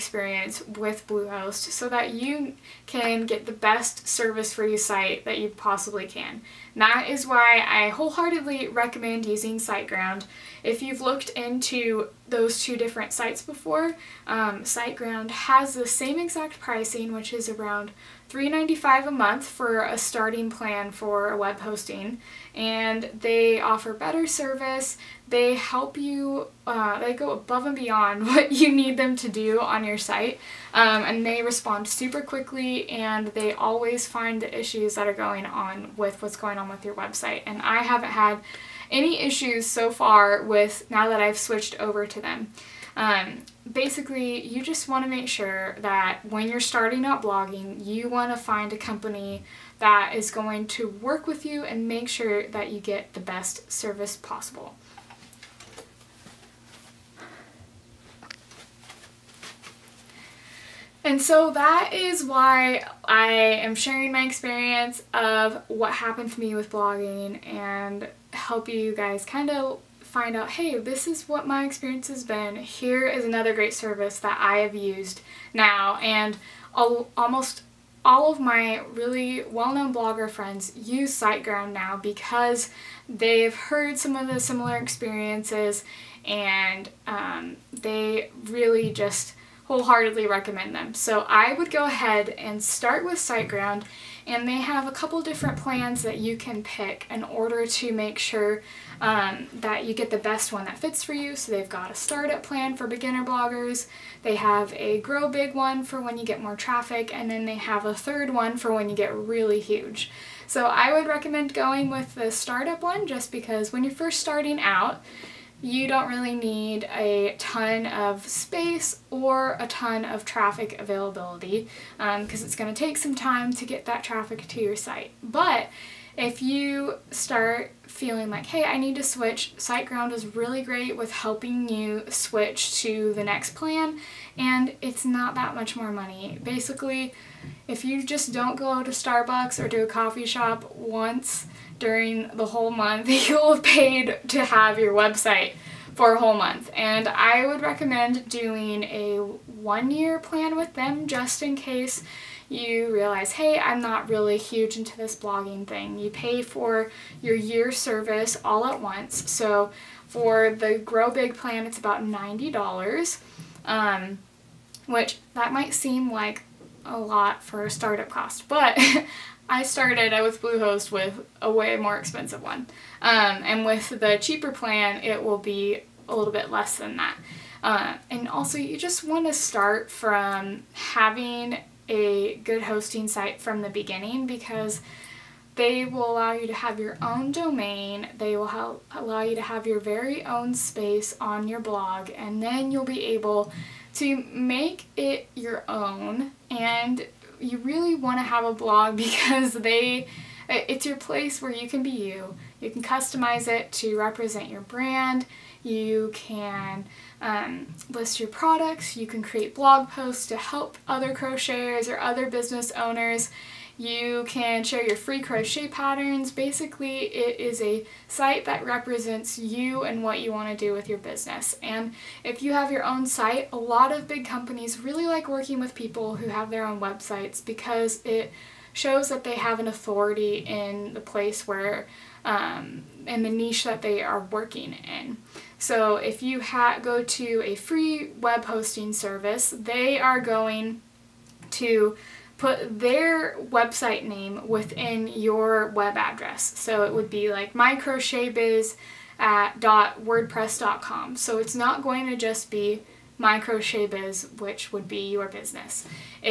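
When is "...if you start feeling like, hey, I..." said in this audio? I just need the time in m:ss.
2:06.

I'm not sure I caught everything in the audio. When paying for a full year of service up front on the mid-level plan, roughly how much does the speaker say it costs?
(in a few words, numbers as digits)
$90.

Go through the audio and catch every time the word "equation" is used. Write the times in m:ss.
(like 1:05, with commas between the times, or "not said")
not said.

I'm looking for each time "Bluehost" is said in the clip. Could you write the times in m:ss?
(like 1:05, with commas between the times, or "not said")
0:01, 2:50.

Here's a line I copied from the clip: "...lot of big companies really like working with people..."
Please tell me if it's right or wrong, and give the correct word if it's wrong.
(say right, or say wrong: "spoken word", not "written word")
right.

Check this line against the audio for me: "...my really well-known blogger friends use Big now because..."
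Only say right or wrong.
wrong.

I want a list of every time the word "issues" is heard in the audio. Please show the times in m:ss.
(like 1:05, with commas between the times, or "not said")
0:34, 0:39.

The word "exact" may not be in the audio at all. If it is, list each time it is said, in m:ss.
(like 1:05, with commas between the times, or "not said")
0:16.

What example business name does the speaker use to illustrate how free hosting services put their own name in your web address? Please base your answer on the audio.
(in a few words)
mycrochetbiz.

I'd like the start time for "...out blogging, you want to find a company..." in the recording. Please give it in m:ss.
0:47.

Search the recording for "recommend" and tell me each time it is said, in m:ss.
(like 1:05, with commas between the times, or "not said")
0:08, 1:30, 1:51, 2:27.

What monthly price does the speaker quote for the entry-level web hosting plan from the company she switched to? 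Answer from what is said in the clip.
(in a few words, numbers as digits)
$3.95.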